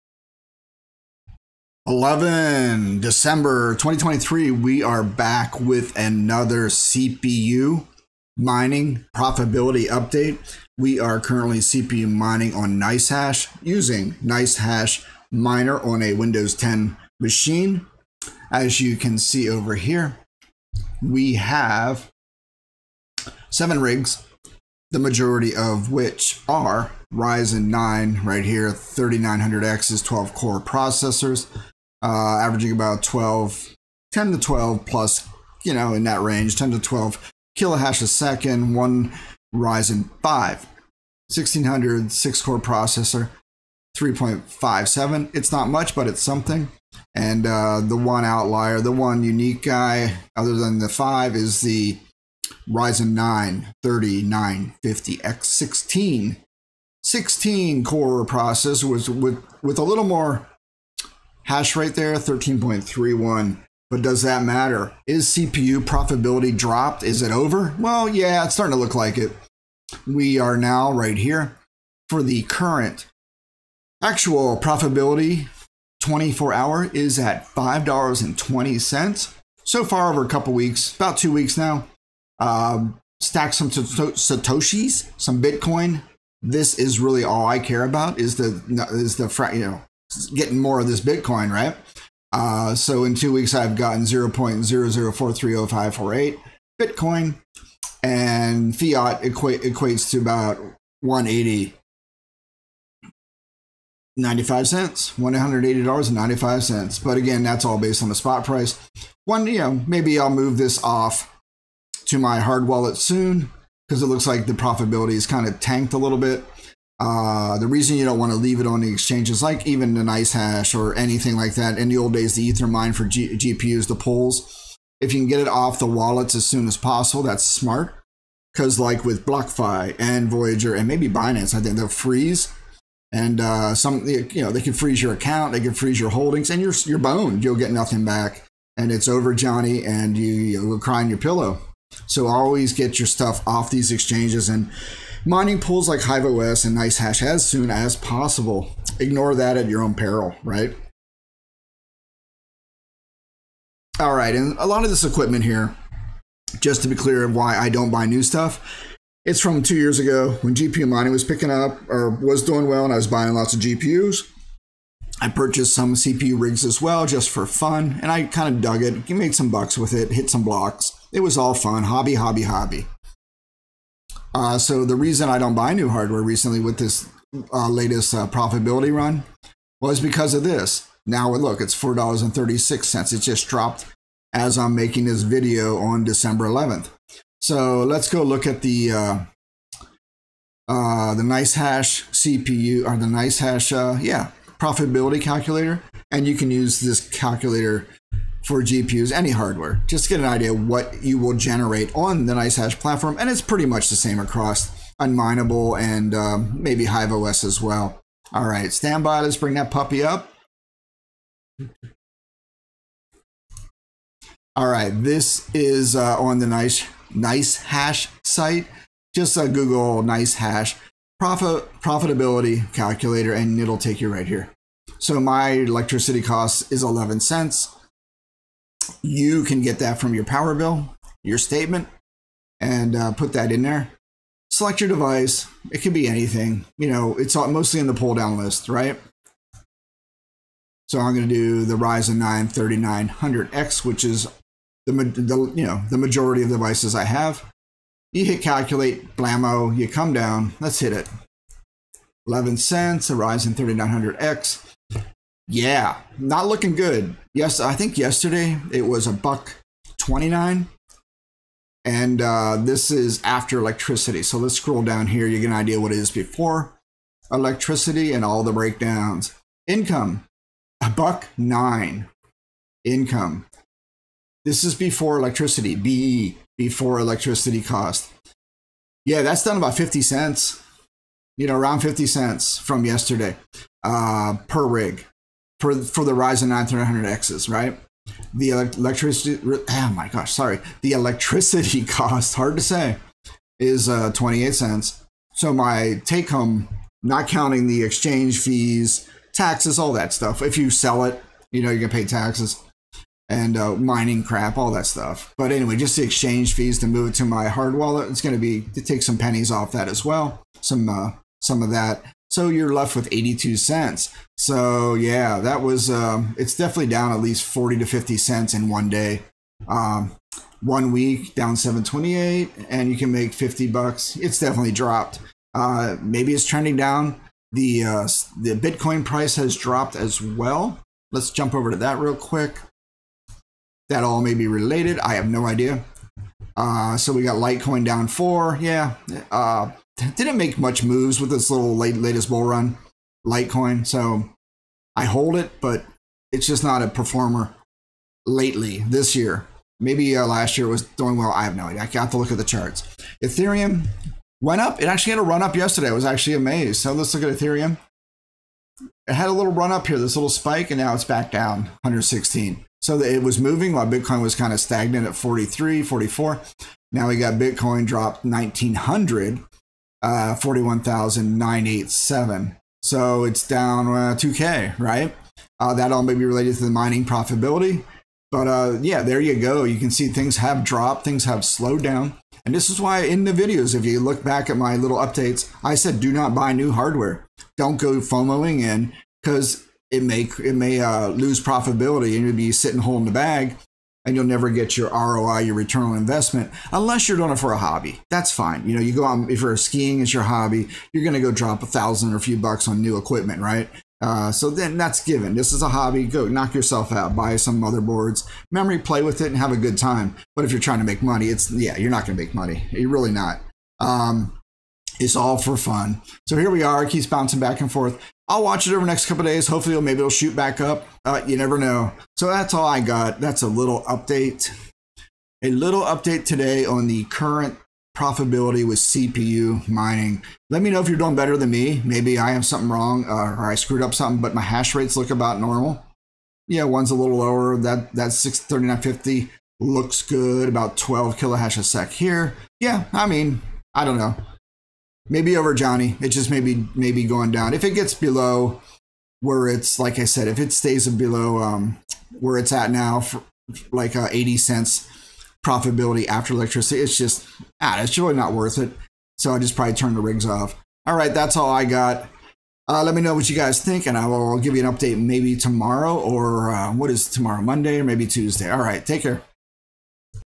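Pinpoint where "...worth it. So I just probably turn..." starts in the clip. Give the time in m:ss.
7:38.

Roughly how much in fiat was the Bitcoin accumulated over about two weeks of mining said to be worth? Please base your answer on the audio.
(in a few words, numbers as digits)
$180.95.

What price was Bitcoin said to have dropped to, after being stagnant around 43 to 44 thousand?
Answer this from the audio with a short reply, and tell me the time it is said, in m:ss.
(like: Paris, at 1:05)
41,987, at 6:10.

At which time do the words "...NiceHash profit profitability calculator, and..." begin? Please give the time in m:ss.
3:40.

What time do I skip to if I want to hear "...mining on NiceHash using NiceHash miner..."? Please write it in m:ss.
0:12.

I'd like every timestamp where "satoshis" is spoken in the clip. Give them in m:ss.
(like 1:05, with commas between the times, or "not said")
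1:23.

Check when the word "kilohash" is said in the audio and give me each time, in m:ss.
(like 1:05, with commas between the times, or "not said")
0:37, 7:21.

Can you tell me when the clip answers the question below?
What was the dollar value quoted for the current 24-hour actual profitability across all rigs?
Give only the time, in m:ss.
1:17.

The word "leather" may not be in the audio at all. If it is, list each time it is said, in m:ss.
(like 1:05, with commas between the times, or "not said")
not said.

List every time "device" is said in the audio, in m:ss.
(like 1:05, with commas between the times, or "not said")
3:54, 4:06.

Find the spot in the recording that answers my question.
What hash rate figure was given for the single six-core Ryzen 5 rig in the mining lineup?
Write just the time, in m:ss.
0:43.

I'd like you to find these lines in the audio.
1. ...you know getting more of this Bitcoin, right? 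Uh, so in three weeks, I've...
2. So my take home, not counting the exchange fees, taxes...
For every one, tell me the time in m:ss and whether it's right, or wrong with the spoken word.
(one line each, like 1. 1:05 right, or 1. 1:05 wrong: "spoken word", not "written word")
1. 1:29 wrong: "two", not "three"
2. 4:55 right.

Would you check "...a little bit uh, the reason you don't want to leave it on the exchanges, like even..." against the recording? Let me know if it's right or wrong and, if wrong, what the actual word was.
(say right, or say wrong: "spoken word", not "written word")
right.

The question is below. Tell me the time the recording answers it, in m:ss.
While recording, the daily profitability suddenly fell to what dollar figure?
3:01.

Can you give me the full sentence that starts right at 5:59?
It had a little run up here, this little spike, and now it's back down 116.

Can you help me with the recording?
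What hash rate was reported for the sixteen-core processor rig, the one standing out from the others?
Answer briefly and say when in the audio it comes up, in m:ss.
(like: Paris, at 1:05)
13.31, at 1:02.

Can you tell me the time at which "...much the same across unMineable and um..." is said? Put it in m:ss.
3:23.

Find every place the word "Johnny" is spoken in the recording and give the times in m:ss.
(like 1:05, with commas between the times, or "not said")
2:19, 7:25.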